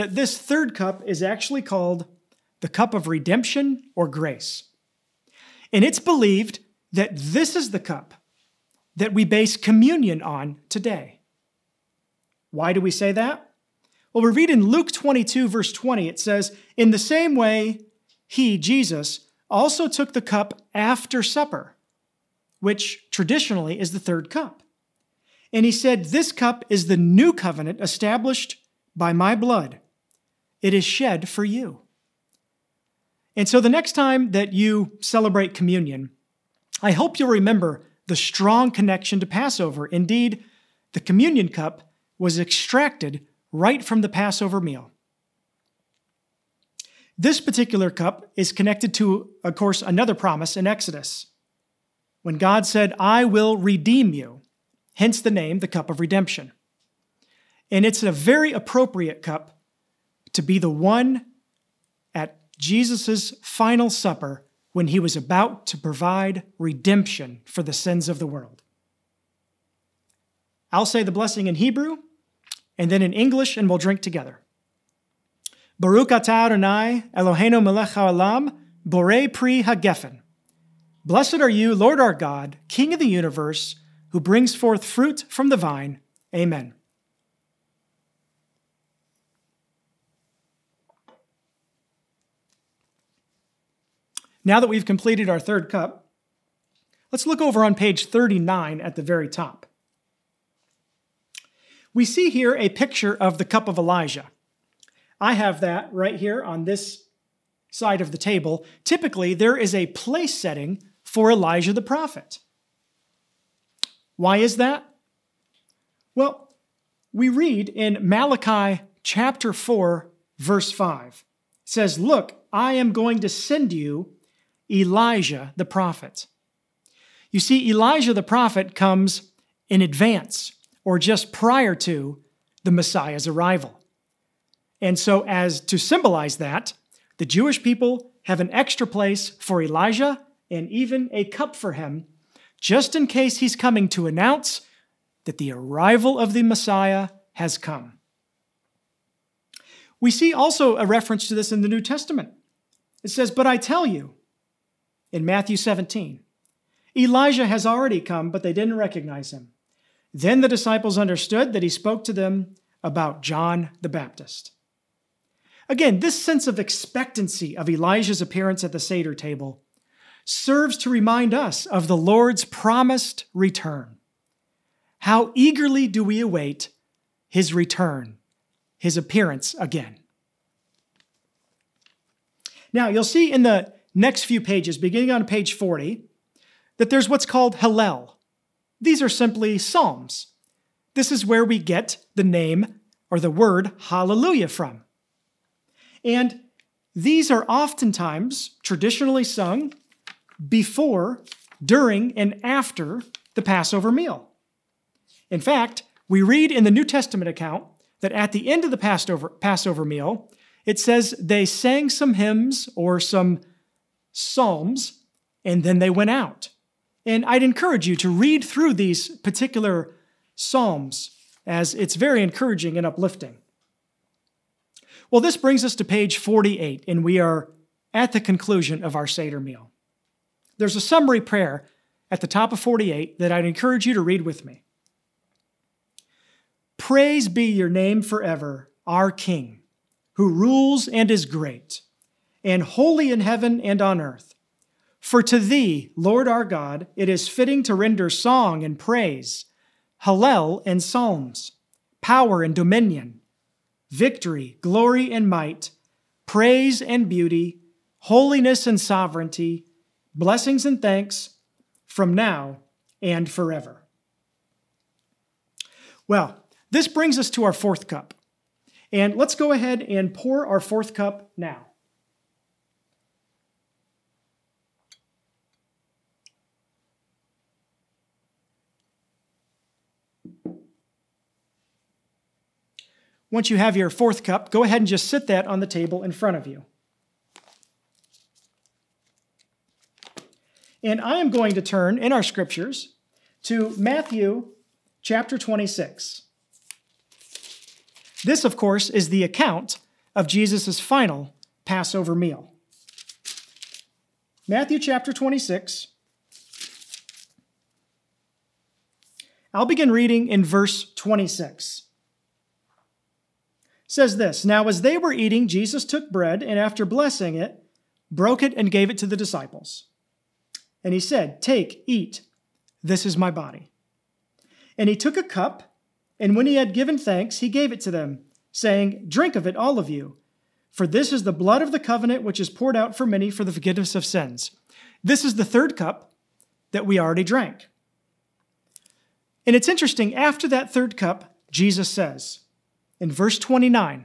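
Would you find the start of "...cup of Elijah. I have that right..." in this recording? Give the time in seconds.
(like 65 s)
103 s.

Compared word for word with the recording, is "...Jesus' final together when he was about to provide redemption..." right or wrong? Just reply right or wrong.
wrong.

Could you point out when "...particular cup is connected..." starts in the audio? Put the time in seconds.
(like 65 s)
47 s.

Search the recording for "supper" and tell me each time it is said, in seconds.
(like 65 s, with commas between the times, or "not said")
21 s, 63 s.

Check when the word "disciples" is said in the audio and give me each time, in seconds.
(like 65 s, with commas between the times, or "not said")
160 s, 319 s.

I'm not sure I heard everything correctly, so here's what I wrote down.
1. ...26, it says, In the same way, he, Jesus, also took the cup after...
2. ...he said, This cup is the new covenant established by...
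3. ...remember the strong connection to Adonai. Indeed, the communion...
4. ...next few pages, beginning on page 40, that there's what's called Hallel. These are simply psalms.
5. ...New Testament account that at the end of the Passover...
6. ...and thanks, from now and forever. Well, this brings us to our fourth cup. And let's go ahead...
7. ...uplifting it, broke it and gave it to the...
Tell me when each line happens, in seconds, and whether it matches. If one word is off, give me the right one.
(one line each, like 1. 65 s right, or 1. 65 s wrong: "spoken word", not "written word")
1. 15 s wrong: "20", not "26"
2. 25 s right
3. 37 s wrong: "Passover", not "Adonai"
4. 183 s right
5. 206 s right
6. 260 s right
7. 316 s wrong: "blessing", not "uplifting".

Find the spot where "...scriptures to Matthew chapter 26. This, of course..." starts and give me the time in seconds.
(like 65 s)
292 s.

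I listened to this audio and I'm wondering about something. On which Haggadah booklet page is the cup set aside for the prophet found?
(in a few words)
39.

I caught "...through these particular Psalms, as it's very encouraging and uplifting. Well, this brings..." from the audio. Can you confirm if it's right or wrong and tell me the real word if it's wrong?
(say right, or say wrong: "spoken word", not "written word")
right.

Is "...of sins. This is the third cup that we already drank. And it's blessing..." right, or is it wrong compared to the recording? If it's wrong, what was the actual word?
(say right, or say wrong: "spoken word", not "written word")
wrong: "interesting", not "blessing".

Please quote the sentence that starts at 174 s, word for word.
How eagerly do we await his return, his appearance again?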